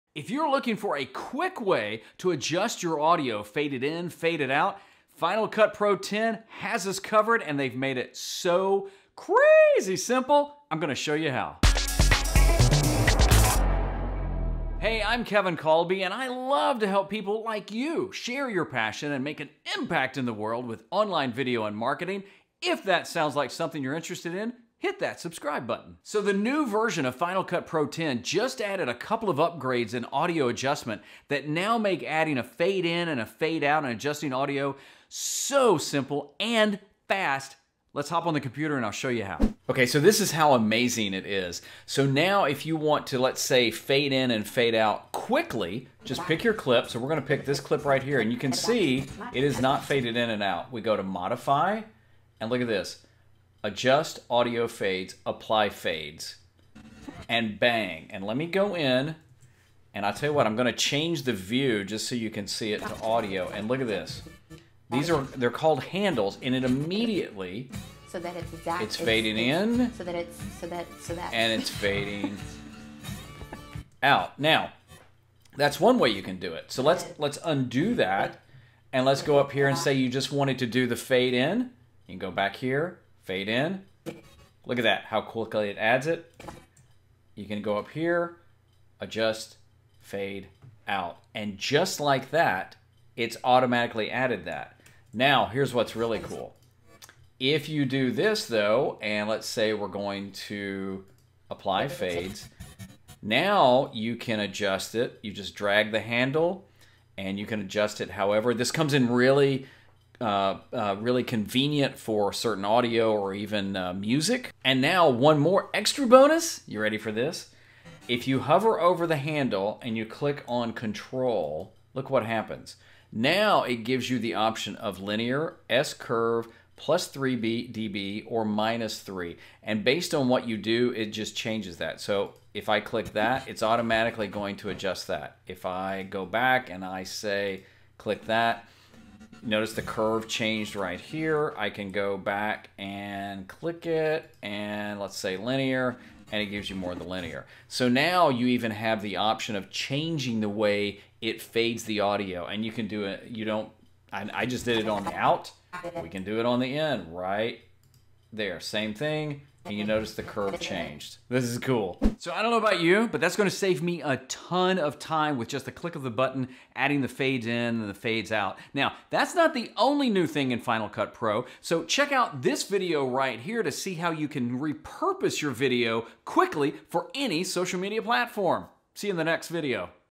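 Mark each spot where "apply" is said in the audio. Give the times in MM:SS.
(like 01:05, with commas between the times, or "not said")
00:55, 01:41.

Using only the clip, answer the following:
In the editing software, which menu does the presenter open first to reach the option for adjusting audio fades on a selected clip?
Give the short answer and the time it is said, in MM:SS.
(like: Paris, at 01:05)
Modify, at 00:51.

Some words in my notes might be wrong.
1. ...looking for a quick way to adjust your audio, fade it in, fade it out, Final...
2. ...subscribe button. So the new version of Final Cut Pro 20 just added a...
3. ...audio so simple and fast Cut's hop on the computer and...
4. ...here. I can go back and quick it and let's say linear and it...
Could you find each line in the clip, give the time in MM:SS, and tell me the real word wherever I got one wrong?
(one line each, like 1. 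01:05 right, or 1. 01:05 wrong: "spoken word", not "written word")
1. 00:00 right
2. 00:25 wrong: "10", not "20"
3. 00:34 wrong: "Let", not "Cut"
4. 02:20 wrong: "click", not "quick".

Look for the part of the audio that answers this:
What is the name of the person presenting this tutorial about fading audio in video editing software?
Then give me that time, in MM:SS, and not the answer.
00:15.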